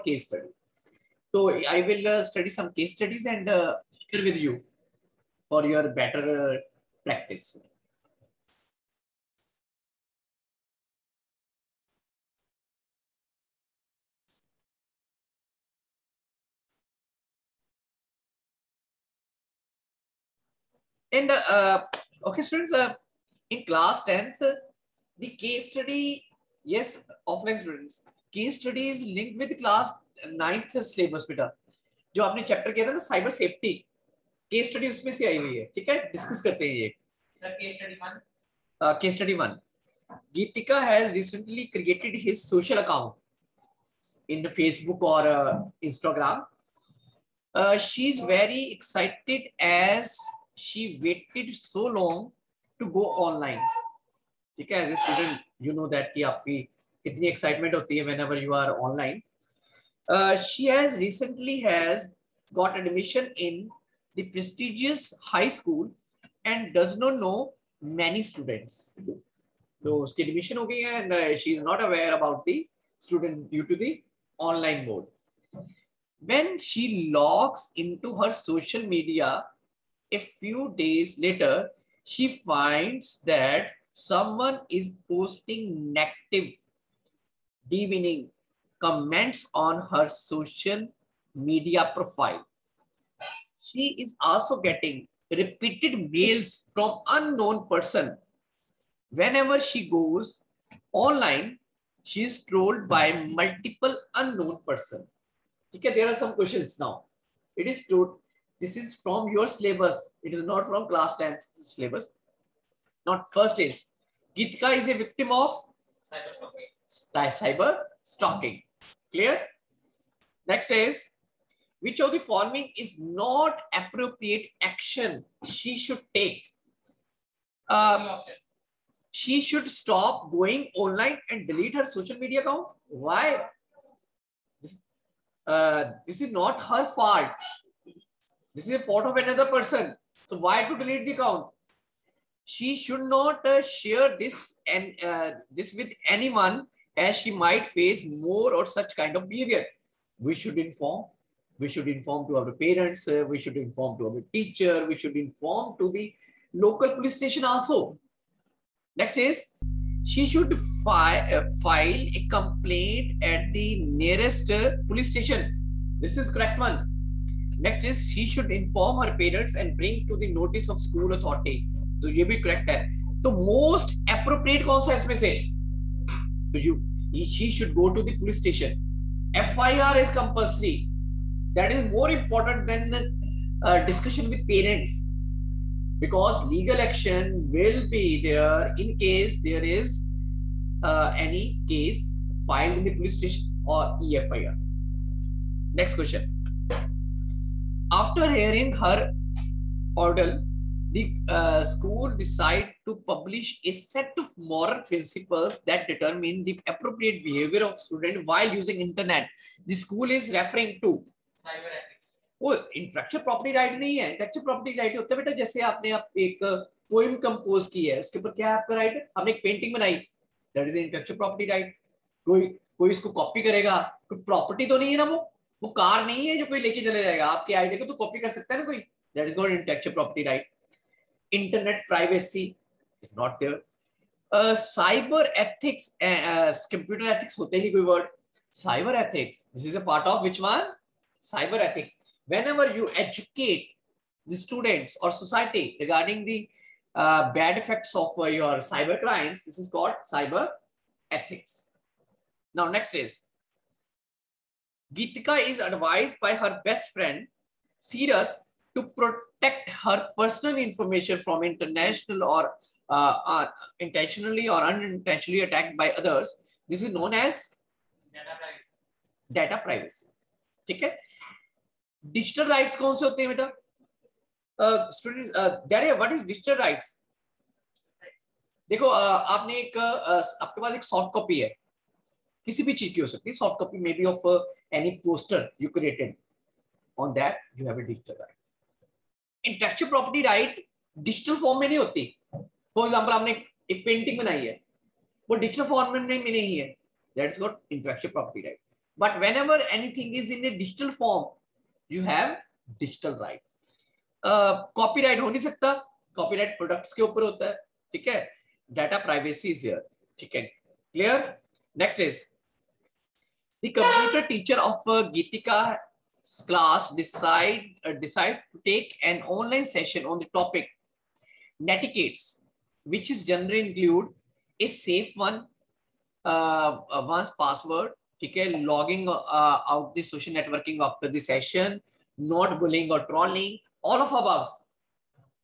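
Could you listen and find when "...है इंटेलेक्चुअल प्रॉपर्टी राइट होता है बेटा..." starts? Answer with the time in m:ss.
3:33.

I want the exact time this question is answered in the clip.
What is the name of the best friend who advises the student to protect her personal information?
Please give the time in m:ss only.
4:17.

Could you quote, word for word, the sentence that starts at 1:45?
Okay, there are some questions now.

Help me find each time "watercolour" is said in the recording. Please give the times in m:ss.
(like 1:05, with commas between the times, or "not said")
not said.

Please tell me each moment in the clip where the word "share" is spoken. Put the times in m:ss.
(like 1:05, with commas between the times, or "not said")
0:04, 2:23.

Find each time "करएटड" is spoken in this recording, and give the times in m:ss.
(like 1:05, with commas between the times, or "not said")
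0:41, 4:45.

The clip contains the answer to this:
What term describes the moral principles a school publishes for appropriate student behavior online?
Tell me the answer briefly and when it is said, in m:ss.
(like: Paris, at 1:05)
Cyber ethics, at 4:01.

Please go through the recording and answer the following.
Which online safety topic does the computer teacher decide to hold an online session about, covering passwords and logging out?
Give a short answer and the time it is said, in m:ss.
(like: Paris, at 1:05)
Netiquettes, at 5:21.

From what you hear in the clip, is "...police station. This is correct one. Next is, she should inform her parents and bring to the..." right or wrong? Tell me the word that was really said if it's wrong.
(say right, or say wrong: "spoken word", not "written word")
right.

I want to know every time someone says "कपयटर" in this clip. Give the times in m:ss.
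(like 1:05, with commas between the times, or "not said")
3:56, 5:13.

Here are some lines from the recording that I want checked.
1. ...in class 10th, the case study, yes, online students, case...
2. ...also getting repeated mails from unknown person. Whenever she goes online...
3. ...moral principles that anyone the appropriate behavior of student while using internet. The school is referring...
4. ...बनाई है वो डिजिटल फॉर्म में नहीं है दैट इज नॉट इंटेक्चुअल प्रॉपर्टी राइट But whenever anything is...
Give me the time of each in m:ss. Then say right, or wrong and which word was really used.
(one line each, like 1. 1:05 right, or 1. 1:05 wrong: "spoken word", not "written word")
1. 0:23 wrong: "offline", not "online"
2. 1:34 right
3. 3:24 wrong: "determine", not "anyone"
4. 4:54 right.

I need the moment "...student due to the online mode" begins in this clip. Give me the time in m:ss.
1:12.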